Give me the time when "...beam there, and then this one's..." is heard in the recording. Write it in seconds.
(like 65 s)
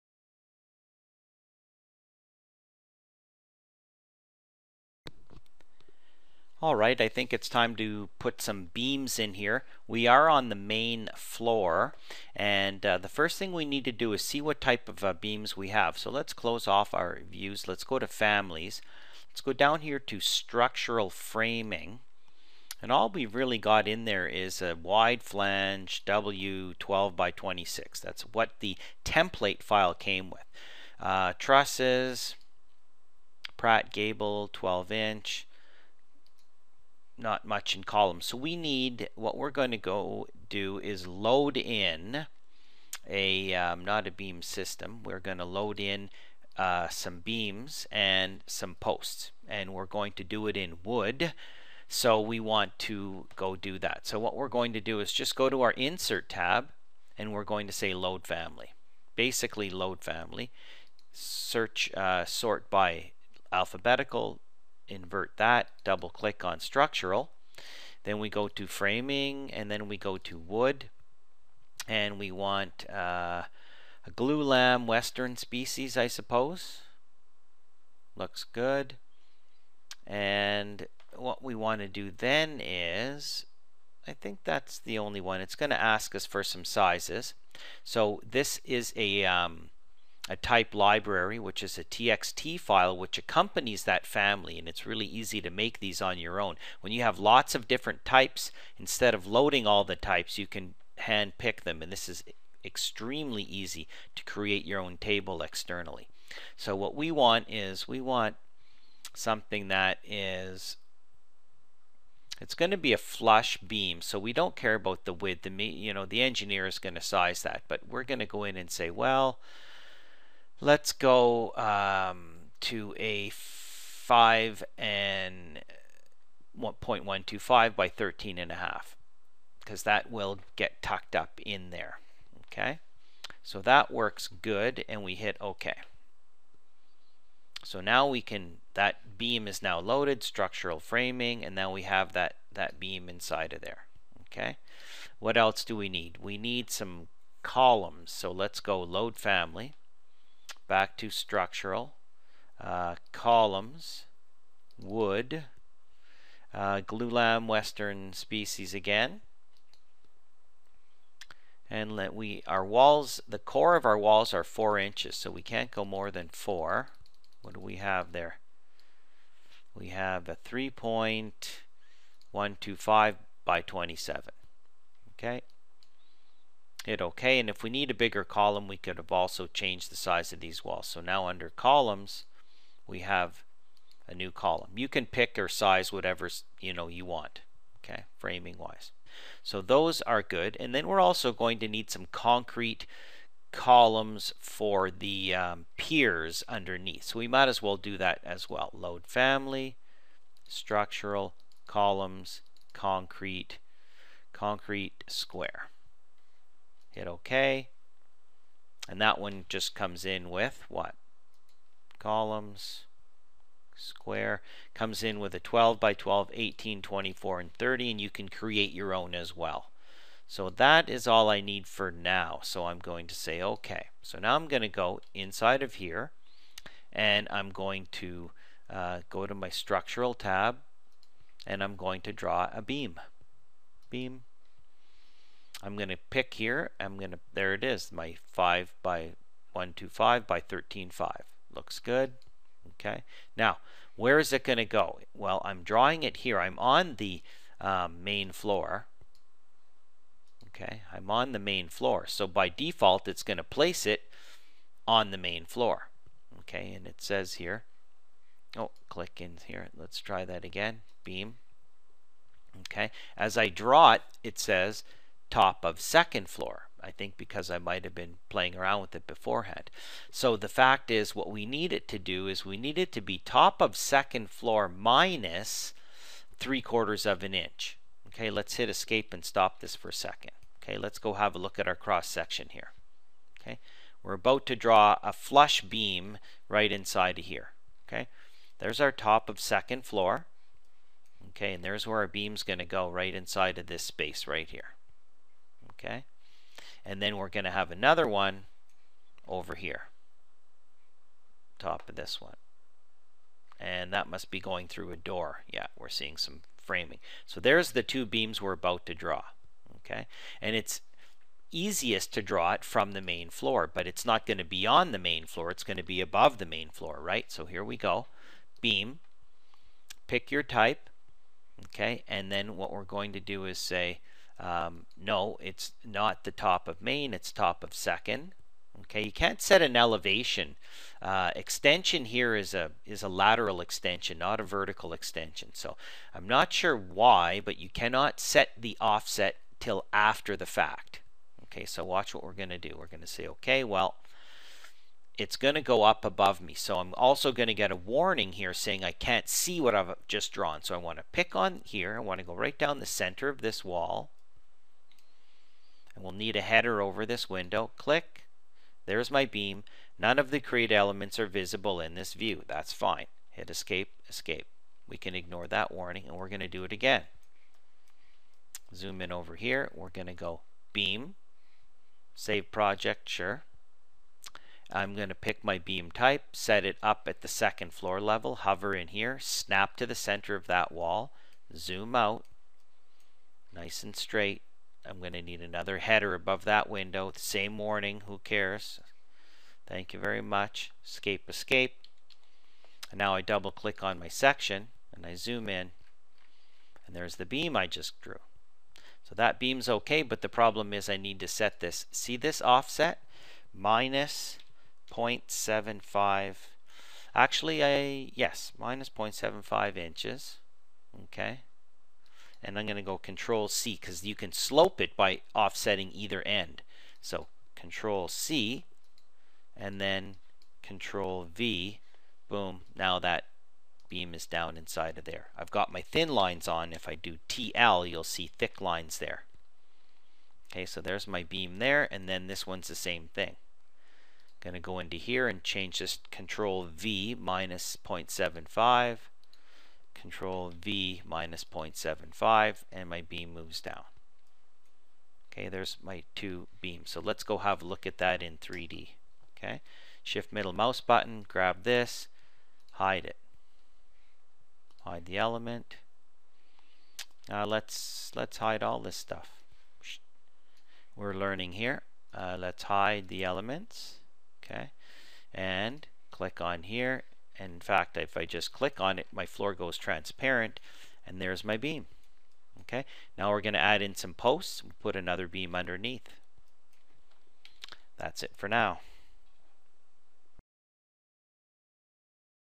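431 s.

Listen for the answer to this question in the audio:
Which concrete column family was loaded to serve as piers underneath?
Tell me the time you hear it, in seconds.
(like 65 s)
204 s.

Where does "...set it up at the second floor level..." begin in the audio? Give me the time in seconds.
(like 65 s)
376 s.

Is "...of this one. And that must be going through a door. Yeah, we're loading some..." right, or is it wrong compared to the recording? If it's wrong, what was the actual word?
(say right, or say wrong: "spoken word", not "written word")
wrong: "seeing", not "loading".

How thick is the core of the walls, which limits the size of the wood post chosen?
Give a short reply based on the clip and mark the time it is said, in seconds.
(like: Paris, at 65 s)
4 inches, at 164 s.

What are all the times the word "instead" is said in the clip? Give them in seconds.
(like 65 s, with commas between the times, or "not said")
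98 s.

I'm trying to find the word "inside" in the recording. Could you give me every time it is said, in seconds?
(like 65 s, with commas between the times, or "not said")
143 s, 225 s, 286 s, 293 s, 424 s.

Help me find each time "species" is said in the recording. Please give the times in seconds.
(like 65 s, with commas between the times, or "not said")
75 s, 158 s.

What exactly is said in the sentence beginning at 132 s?
Okay, so that works good and we hit OK.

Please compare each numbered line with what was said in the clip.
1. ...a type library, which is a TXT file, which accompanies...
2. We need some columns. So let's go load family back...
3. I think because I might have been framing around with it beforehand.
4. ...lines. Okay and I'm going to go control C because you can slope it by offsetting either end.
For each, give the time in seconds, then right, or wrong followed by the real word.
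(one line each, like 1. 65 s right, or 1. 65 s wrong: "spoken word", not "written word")
1. 90 s right
2. 146 s right
3. 266 s wrong: "playing", not "framing"
4. 409 s wrong: "inches", not "lines".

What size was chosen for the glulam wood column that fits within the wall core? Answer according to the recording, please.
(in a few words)
3.125 by 27.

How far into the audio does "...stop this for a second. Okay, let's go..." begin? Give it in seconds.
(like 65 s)
279 s.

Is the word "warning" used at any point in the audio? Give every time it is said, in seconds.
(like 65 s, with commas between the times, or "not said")
347 s, 365 s, 387 s.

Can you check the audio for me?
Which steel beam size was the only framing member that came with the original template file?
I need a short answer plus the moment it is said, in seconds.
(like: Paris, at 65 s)
W12 by 26, at 26 s.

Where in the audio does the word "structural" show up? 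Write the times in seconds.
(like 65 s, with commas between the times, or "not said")
20 s, 66 s, 140 s, 151 s, 200 s, 229 s.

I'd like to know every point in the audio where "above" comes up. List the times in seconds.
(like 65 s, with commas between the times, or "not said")
316 s, 346 s, 386 s.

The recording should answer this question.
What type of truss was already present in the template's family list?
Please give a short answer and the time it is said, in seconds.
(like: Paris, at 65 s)
Pratt Gable 12 inch, at 33 s.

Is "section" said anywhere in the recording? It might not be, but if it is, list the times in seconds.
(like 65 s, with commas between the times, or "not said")
282 s, 394 s.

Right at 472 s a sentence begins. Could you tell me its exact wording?
Okay, now we're going to add in some posts and put another beam underneath.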